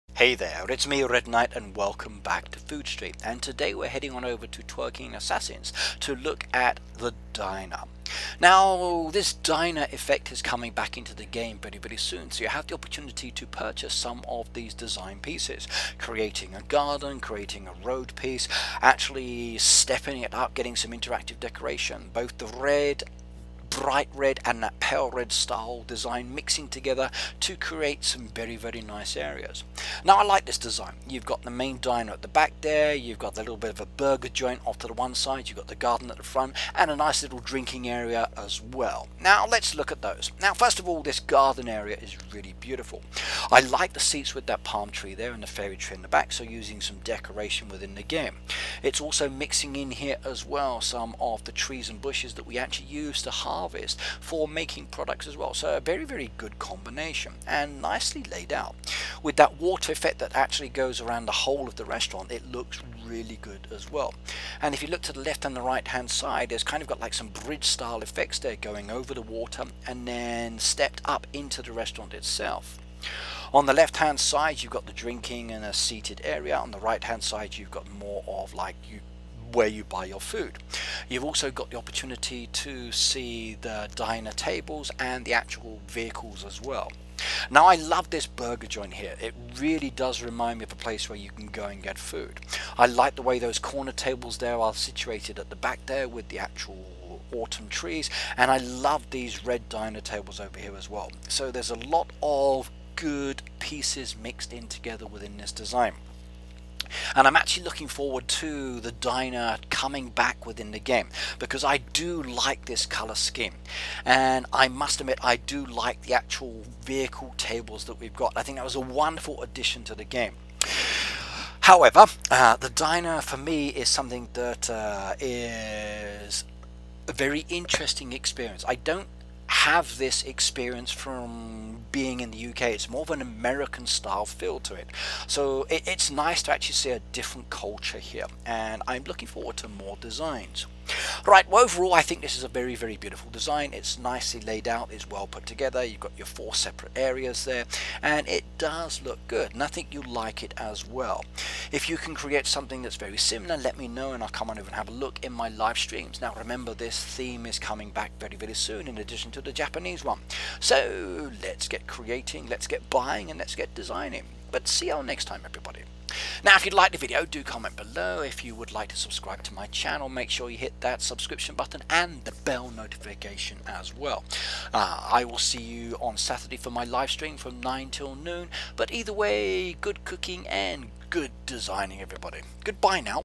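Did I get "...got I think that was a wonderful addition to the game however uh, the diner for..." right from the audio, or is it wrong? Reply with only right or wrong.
right.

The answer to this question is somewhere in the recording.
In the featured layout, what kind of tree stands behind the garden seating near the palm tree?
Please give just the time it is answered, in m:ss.
0:45.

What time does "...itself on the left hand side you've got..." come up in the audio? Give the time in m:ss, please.
1:12.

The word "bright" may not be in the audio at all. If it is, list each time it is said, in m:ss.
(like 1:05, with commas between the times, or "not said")
0:23.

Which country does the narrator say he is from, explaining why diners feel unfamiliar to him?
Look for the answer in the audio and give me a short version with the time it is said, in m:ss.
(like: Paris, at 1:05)
UK, at 2:12.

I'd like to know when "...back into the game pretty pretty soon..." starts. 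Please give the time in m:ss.
0:10.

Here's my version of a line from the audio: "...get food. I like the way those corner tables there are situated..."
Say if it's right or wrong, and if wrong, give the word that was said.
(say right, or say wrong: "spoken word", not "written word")
right.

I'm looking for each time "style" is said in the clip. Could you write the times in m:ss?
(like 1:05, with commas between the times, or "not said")
0:25, 1:07, 2:13.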